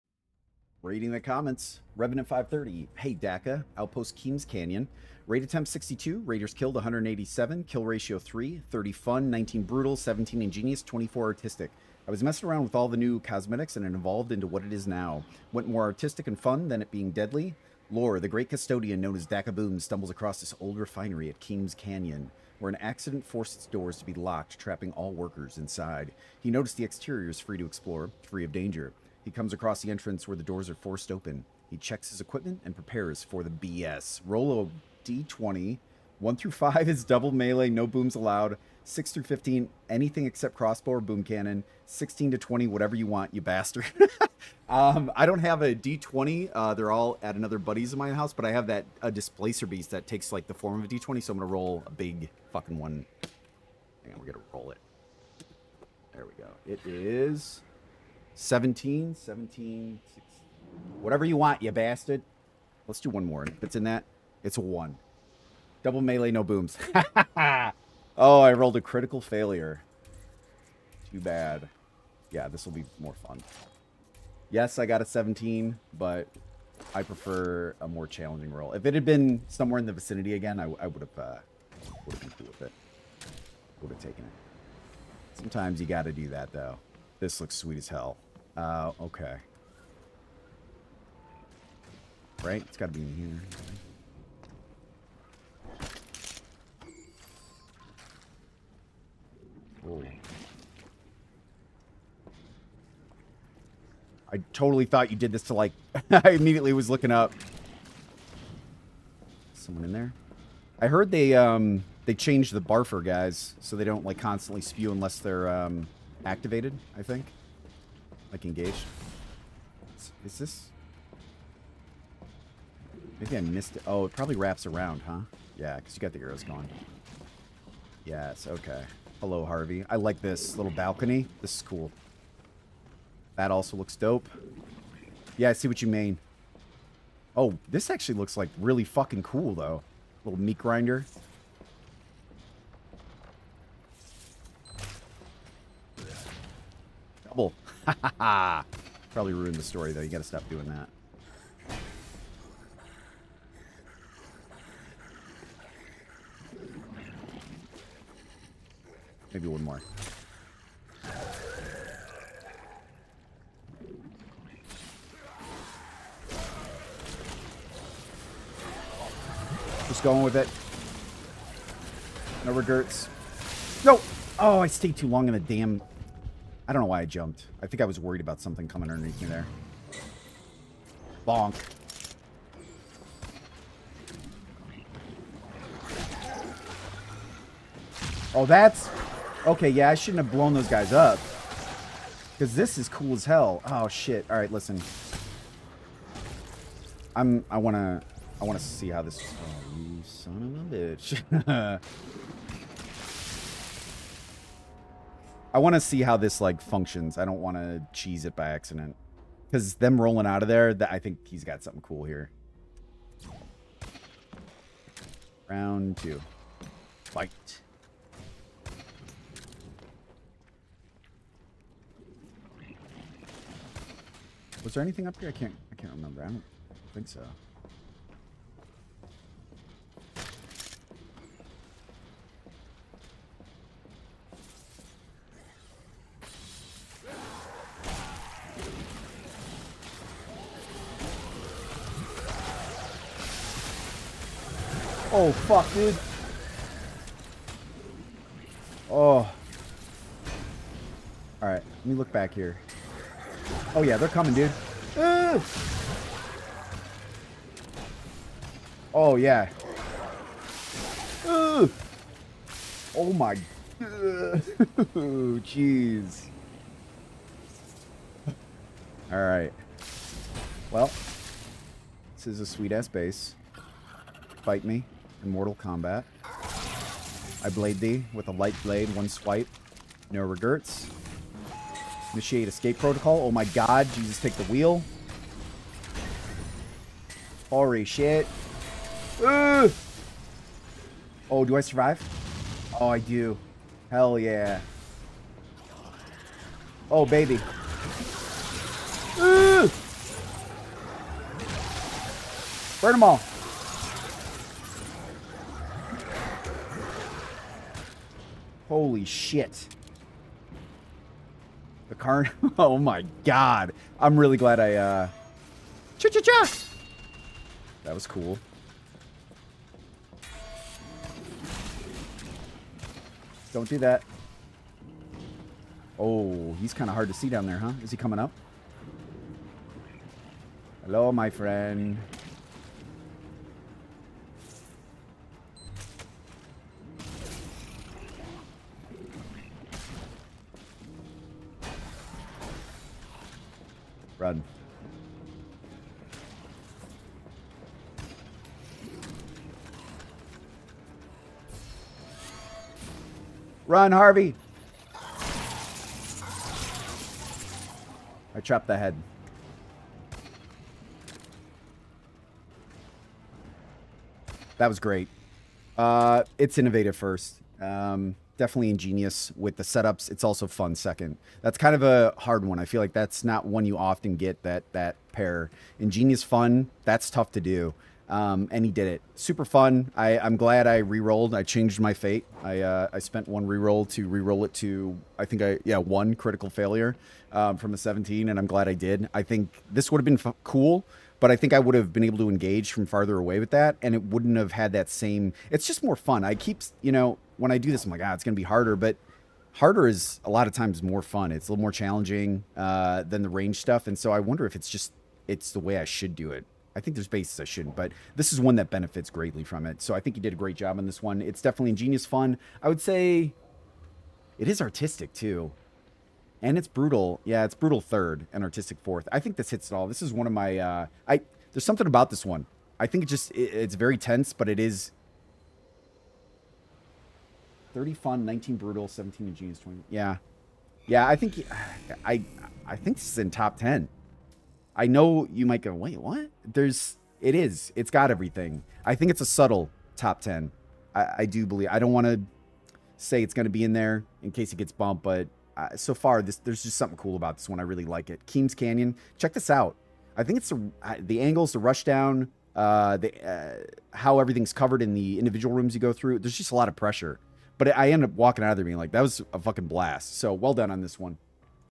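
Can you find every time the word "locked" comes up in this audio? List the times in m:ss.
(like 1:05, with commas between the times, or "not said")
0:24.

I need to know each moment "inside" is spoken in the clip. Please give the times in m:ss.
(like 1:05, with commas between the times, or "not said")
0:25.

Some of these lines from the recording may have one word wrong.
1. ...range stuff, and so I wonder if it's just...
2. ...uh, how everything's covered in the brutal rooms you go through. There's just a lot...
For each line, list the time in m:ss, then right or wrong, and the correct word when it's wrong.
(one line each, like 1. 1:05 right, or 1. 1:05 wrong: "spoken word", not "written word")
1. 6:43 right
2. 7:33 wrong: "individual", not "brutal".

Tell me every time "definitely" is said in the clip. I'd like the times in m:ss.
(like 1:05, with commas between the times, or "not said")
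6:08, 6:51.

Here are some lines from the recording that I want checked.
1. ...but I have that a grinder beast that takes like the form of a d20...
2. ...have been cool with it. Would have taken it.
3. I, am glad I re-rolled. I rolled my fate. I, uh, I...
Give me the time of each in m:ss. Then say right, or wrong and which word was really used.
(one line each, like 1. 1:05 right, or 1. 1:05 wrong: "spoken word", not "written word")
1. 0:48 wrong: "displacer", not "grinder"
2. 1:22 right
3. 6:19 wrong: "changed", not "rolled".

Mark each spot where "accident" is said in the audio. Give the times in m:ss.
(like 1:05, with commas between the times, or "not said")
0:22, 3:28.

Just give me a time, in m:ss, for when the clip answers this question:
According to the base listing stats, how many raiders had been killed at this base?
0:06.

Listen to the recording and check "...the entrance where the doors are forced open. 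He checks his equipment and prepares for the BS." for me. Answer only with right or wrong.
right.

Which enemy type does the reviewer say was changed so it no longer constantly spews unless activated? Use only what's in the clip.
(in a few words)
The barfer.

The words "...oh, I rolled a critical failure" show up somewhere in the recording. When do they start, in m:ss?
1:08.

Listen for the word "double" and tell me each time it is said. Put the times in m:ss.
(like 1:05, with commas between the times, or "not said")
0:37, 1:05, 2:27.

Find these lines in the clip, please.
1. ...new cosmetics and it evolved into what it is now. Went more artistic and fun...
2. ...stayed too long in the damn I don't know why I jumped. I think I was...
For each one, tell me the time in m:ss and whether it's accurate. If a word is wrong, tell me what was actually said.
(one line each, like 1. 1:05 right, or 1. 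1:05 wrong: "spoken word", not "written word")
1. 0:12 right
2. 2:54 right.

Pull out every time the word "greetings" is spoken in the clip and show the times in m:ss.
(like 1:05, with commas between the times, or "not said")
not said.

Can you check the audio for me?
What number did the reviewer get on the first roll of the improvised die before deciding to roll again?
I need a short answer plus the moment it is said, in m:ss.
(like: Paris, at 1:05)
17, at 0:56.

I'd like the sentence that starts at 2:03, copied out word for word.
Oh, it probably wraps around, huh?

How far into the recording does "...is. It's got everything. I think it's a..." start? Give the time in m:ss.
7:17.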